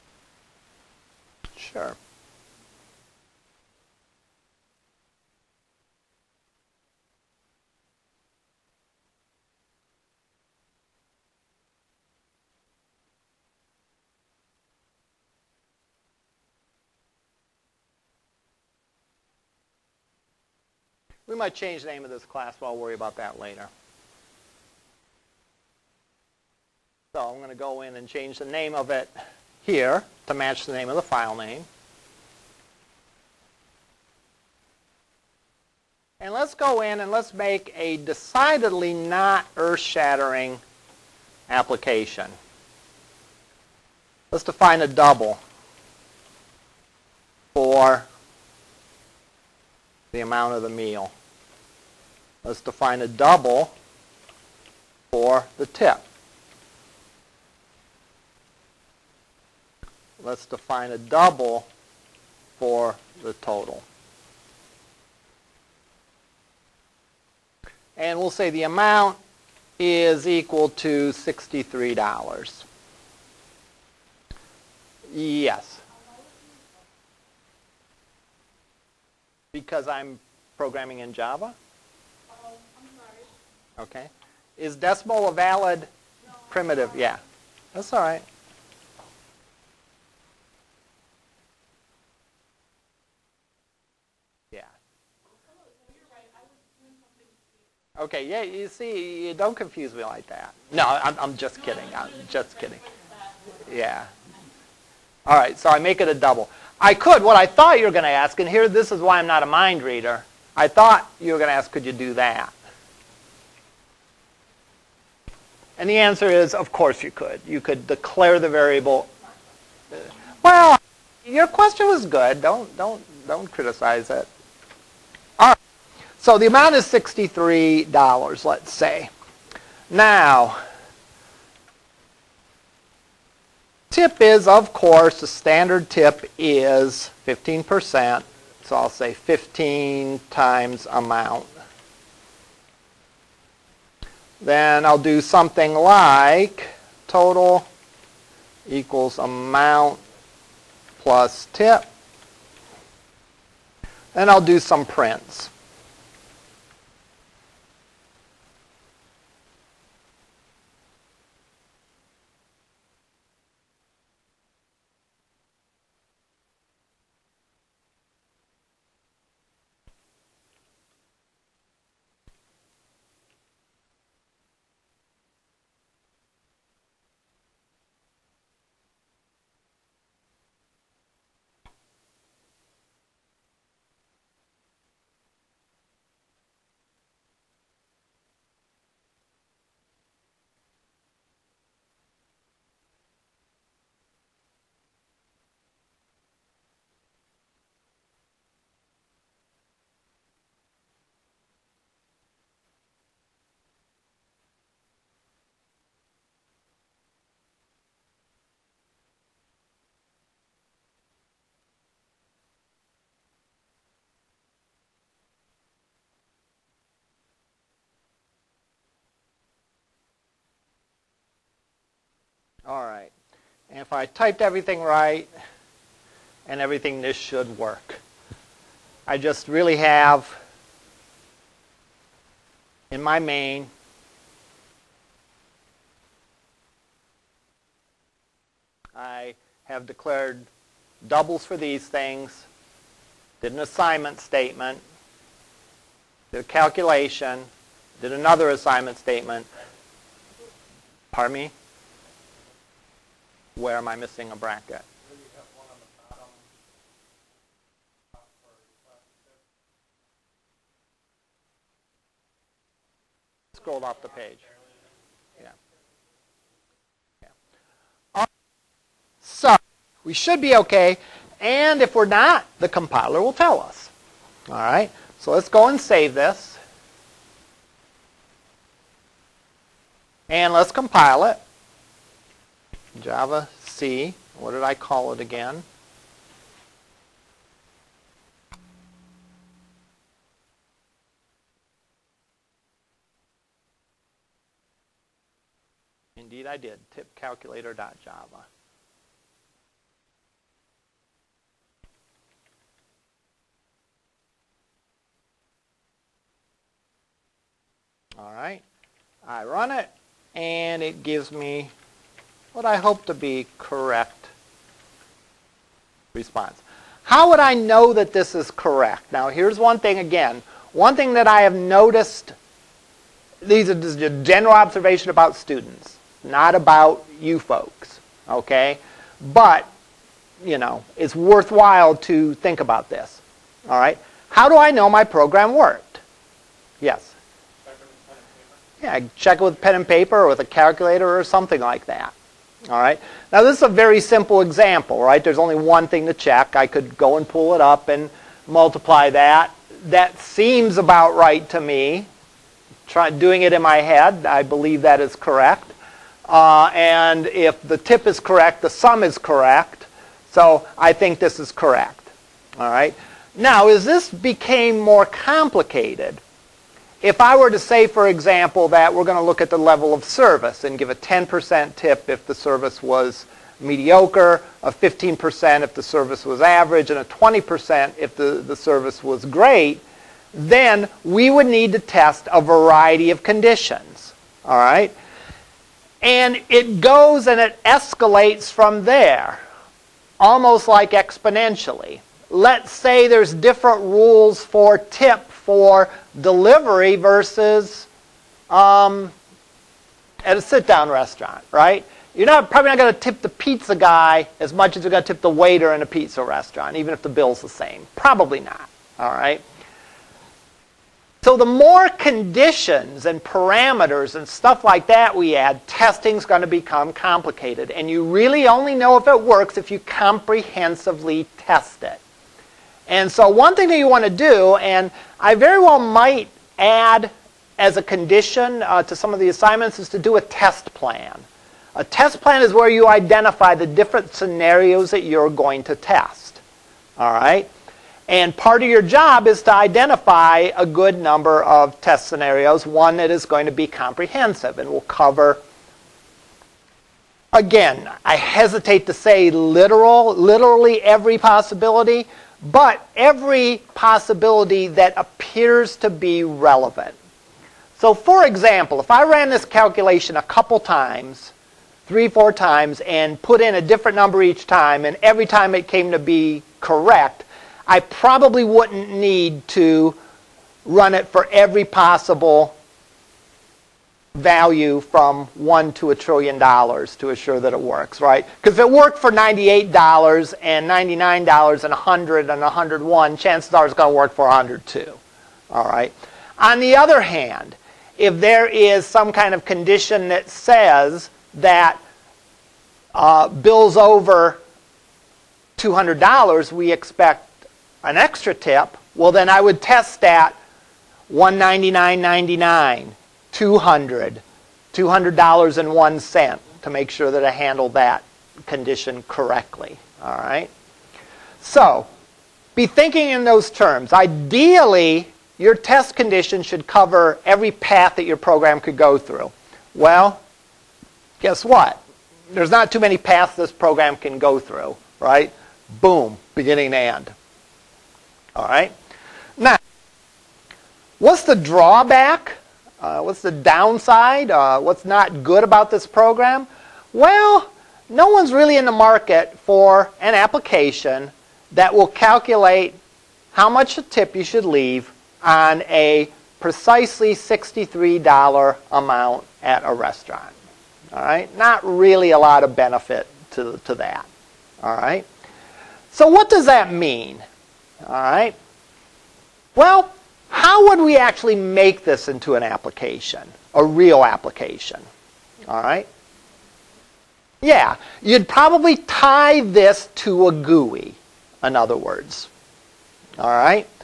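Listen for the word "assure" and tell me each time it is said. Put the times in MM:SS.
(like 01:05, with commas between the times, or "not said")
07:57.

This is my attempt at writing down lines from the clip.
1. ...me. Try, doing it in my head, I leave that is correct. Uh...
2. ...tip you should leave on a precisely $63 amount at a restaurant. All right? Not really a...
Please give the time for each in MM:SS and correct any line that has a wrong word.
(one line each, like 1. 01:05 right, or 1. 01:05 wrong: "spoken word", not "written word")
1. 05:51 wrong: "believe", not "leave"
2. 09:03 right.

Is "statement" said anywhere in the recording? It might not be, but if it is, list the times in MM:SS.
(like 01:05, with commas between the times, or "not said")
04:04, 04:08.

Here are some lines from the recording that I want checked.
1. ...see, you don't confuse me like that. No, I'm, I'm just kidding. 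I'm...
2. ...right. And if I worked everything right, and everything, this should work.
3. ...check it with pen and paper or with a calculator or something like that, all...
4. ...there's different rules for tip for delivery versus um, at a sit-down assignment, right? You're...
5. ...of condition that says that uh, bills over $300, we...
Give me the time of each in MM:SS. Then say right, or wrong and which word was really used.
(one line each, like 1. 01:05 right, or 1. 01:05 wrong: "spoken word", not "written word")
1. 01:38 right
2. 03:42 wrong: "typed", not "worked"
3. 05:39 right
4. 06:33 wrong: "restaurant", not "assignment"
5. 08:09 wrong: "200", not "300".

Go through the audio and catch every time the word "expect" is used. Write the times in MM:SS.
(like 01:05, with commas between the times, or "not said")
08:16.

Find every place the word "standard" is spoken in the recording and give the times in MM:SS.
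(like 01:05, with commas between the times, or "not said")
02:15.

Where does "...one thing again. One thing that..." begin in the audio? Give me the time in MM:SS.
05:19.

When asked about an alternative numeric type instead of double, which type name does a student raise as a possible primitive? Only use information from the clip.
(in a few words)
decimal.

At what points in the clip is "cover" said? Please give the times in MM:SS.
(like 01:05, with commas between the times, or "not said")
07:24, 08:36.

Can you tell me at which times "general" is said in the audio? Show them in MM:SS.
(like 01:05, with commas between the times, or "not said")
05:24.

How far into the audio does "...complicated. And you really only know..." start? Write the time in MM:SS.
06:56.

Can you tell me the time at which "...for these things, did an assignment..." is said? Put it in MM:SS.
04:01.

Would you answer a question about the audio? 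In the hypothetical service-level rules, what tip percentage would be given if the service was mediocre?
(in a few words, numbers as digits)
10%.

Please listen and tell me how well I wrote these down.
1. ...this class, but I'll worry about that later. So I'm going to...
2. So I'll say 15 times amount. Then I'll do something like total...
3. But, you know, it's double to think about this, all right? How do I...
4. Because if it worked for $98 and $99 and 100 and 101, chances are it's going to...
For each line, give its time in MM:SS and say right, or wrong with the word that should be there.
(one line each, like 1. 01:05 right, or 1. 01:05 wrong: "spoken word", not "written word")
1. 00:22 right
2. 02:18 right
3. 05:29 wrong: "worthwhile", not "double"
4. 07:58 right.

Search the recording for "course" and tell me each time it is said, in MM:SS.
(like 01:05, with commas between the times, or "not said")
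01:56, 02:14.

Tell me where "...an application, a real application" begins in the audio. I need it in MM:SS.
09:22.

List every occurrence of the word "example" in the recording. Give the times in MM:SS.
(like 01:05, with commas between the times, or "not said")
05:44, 06:08, 07:38.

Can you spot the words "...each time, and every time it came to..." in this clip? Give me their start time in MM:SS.
07:44.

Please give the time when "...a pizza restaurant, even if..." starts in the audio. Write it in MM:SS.
06:45.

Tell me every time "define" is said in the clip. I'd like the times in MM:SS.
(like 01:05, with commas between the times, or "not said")
00:44, 00:52, 01:00.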